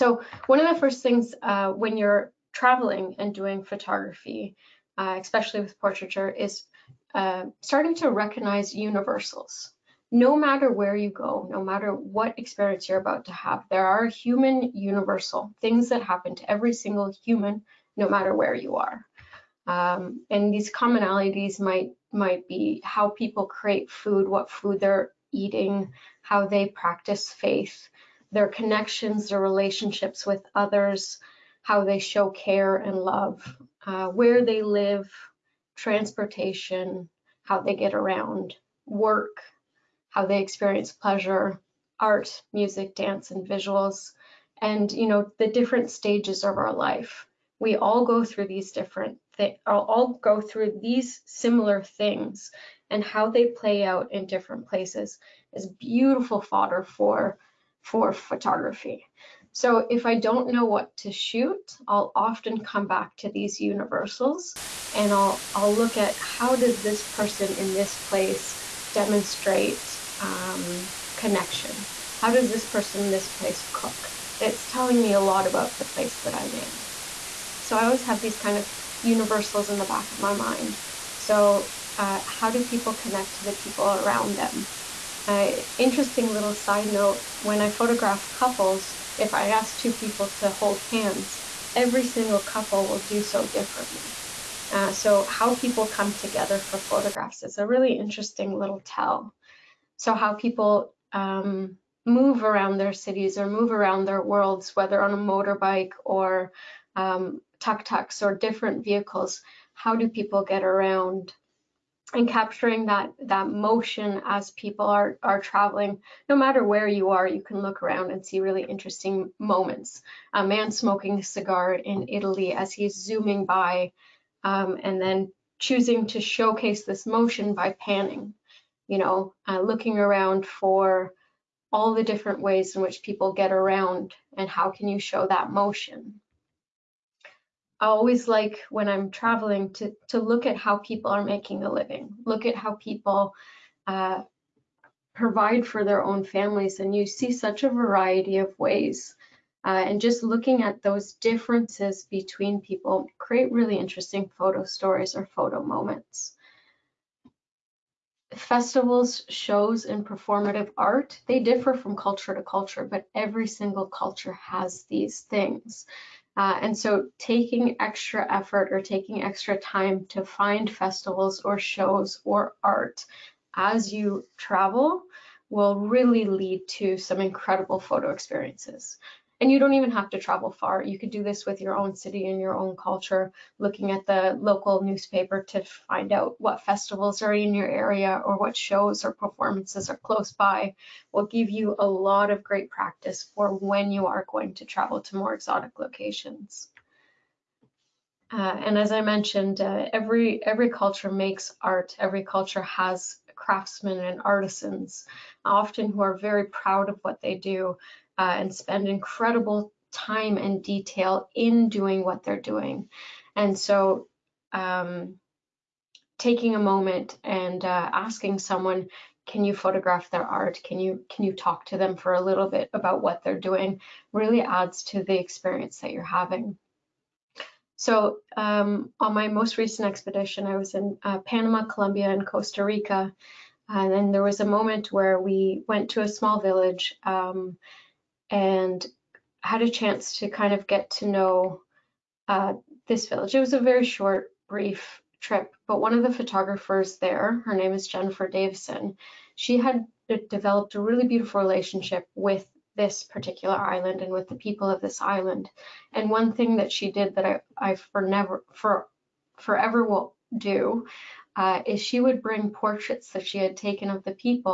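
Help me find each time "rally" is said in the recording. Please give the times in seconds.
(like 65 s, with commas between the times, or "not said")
not said.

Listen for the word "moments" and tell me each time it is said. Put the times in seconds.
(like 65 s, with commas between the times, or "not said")
119 s, 155 s, 216 s, 234 s.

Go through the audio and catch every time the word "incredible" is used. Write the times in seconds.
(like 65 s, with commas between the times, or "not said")
177 s, 208 s.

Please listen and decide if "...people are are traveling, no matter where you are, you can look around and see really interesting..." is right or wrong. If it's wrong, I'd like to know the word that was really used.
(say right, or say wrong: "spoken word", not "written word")
right.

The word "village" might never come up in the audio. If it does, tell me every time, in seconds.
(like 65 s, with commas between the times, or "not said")
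236 s, 243 s.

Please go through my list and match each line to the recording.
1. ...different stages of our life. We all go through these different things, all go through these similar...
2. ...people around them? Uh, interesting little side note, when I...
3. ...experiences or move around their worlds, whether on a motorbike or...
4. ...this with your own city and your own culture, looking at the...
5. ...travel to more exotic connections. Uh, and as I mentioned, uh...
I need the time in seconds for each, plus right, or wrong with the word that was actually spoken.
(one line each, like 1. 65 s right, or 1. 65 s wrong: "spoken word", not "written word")
1. 45 s right
2. 83 s right
3. 102 s wrong: "cities", not "experiences"
4. 181 s right
5. 194 s wrong: "locations", not "connections".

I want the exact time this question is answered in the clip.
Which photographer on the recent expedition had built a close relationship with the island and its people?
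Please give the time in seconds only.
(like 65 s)
247 s.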